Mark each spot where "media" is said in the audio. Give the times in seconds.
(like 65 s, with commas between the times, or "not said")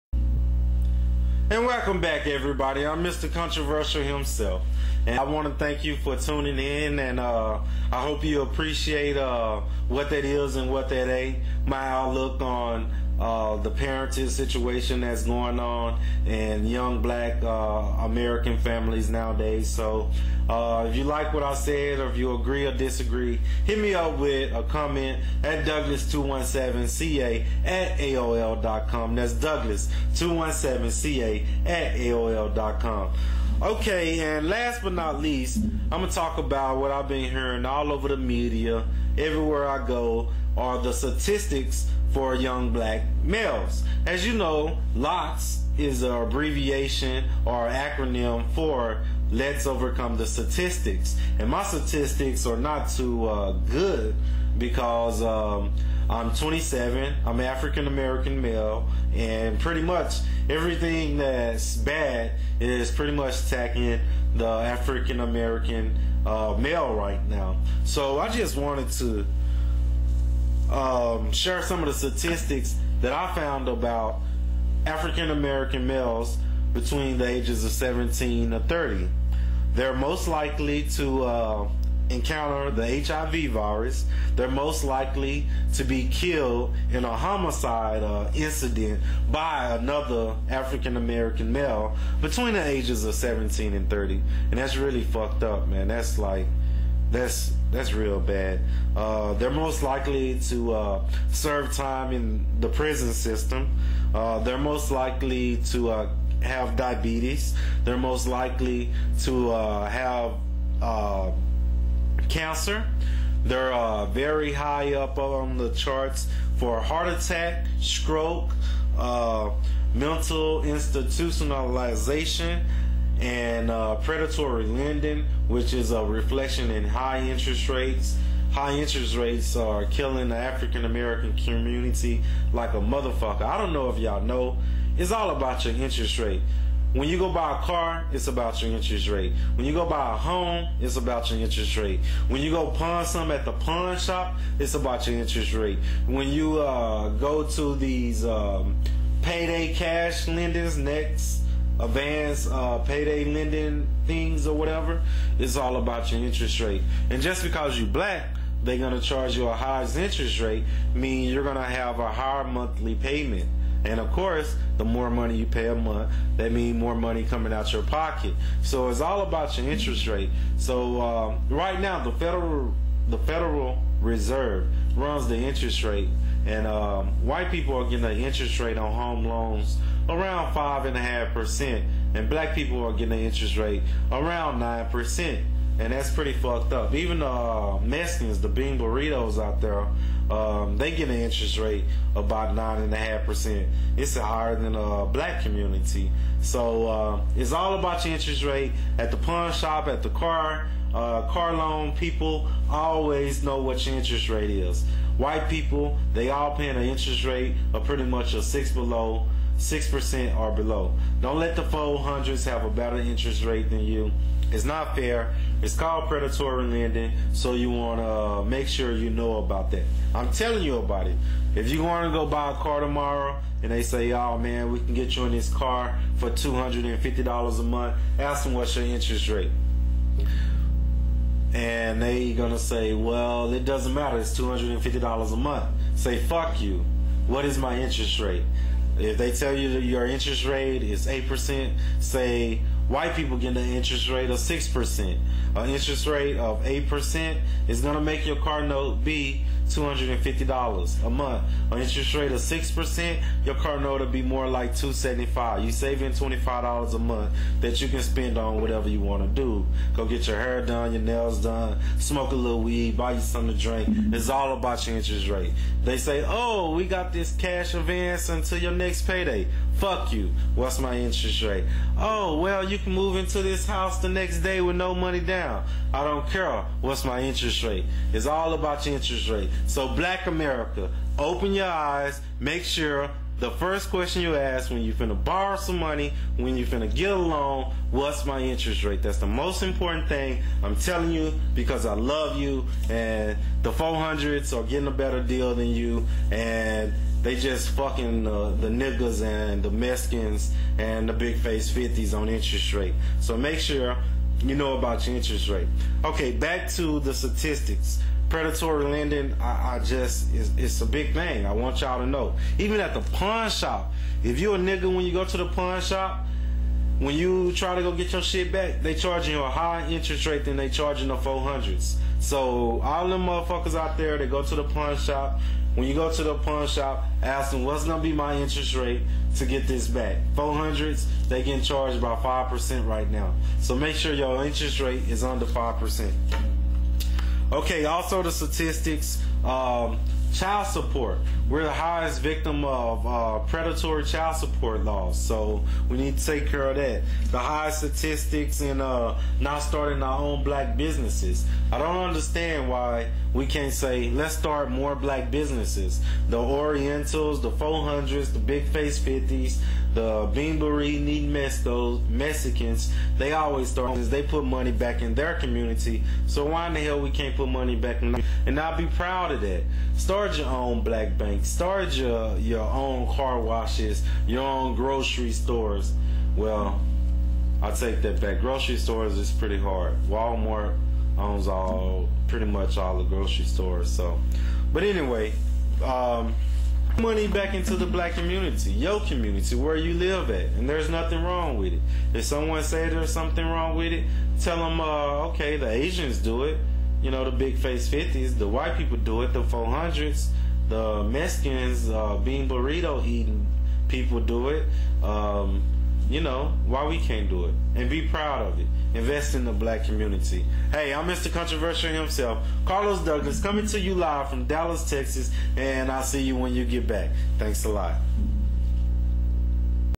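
38 s.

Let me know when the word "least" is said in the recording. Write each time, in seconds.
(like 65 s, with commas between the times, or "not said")
35 s.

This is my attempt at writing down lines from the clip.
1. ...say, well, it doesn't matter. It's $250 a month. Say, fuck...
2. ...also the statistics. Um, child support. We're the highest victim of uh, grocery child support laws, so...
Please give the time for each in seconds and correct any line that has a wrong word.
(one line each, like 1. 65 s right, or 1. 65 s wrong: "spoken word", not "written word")
1. 232 s right
2. 337 s wrong: "predatory", not "grocery".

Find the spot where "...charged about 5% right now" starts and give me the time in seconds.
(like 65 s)
331 s.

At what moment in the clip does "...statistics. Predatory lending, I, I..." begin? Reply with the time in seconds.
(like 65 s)
307 s.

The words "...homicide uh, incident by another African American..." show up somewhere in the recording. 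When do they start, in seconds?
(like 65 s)
87 s.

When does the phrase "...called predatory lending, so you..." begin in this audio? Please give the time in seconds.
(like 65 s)
215 s.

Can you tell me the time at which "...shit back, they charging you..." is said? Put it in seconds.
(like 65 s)
318 s.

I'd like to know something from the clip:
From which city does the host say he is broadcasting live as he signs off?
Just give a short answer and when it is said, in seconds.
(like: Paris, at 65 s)
Dallas, Texas, at 414 s.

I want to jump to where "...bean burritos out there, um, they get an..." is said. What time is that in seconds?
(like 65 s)
188 s.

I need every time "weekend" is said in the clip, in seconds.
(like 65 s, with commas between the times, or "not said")
not said.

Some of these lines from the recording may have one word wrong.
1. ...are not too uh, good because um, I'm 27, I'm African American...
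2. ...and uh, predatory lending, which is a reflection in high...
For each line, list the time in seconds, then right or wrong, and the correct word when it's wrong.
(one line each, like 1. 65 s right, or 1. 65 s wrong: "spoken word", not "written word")
1. 52 s right
2. 123 s right.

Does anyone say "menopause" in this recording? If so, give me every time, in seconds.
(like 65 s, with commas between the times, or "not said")
not said.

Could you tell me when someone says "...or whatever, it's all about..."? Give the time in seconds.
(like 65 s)
154 s.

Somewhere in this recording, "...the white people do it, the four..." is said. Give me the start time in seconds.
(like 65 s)
398 s.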